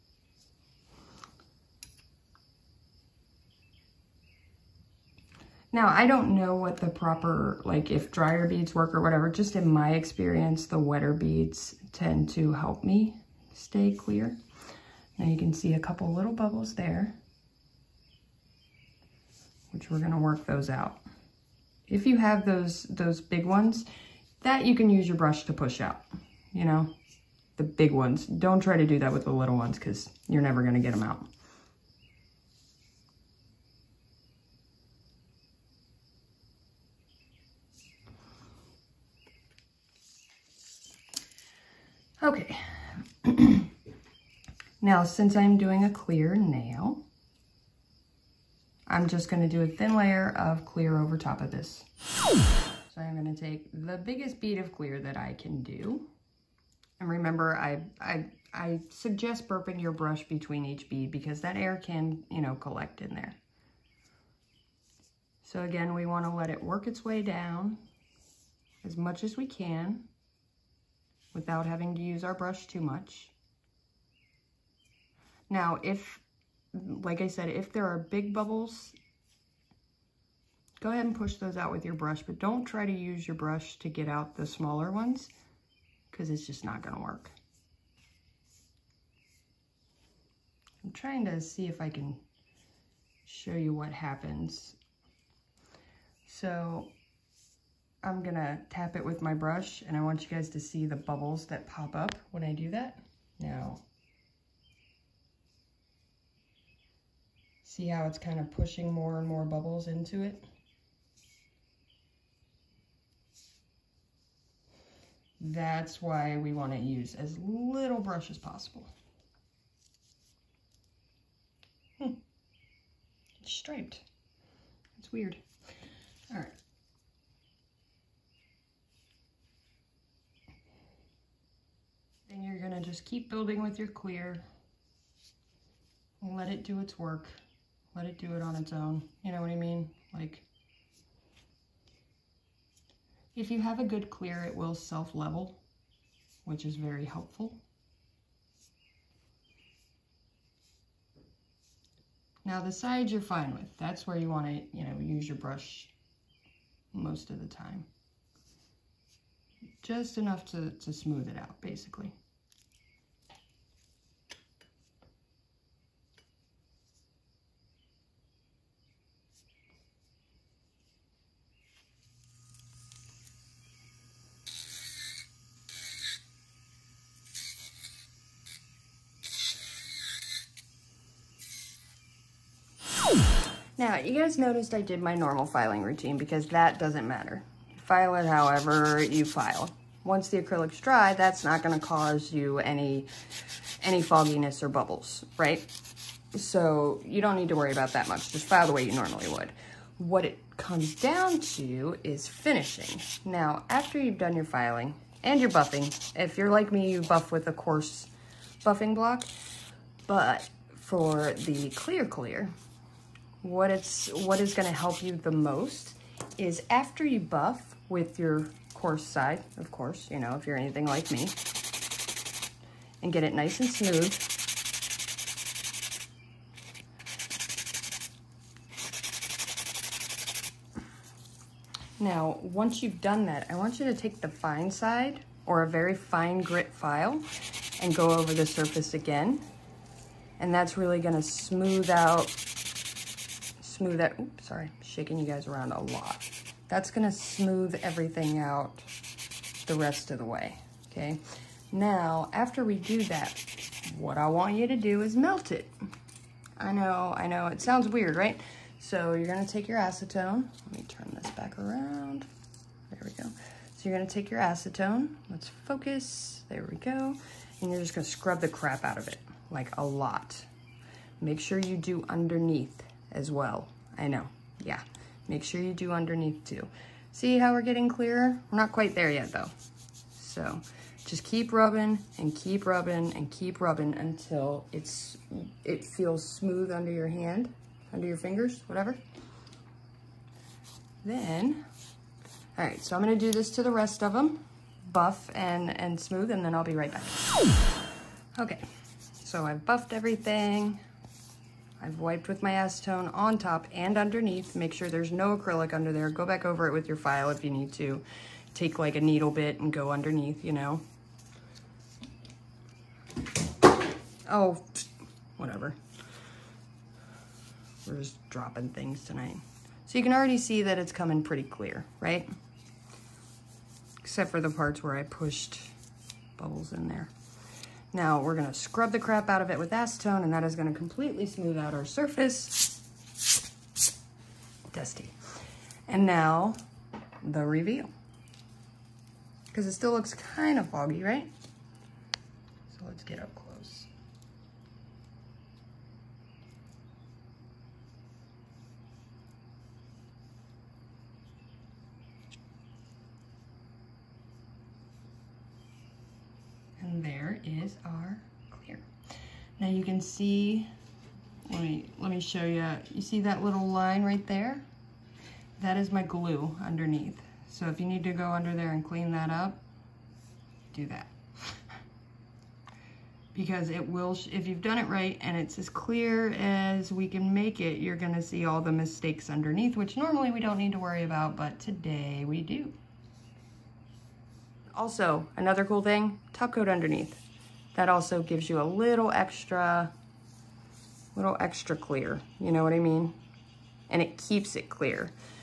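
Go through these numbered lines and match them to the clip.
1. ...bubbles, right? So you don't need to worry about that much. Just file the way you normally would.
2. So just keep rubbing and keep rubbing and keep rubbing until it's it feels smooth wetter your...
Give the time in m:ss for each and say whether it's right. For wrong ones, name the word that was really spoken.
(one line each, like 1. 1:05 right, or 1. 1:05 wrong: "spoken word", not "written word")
1. 3:14 right
2. 4:40 wrong: "under", not "wetter".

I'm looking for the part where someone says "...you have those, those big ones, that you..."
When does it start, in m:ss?
0:22.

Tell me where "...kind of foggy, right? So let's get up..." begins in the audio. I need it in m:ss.
5:40.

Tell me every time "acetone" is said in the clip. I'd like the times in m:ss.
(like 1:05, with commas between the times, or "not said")
4:19, 4:24, 5:02, 5:29.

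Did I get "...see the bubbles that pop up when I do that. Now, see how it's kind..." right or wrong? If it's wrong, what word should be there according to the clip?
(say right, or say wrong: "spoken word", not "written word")
right.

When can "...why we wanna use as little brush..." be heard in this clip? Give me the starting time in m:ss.
1:56.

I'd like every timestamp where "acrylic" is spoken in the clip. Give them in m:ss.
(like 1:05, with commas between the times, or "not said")
3:10, 5:05.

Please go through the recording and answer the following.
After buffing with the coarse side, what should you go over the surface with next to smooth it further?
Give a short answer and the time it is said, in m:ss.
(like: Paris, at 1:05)
the fine side, at 3:54.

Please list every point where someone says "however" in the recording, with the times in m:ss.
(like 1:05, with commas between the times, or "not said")
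3:08.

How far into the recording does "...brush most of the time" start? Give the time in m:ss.
2:35.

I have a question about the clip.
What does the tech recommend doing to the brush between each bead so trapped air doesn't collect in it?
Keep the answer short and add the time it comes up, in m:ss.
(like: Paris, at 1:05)
burping, at 0:59.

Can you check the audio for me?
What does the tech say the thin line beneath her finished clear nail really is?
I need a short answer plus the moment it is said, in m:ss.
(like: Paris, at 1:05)
glue, at 6:06.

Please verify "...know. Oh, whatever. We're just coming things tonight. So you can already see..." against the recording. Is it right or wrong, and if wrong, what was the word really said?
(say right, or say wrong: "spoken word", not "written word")
wrong: "dropping", not "coming".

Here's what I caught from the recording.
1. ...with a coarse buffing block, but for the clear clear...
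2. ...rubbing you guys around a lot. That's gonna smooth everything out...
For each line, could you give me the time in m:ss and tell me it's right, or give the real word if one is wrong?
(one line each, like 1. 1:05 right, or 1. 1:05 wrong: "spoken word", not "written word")
1. 3:27 right
2. 4:04 wrong: "shaking", not "rubbing".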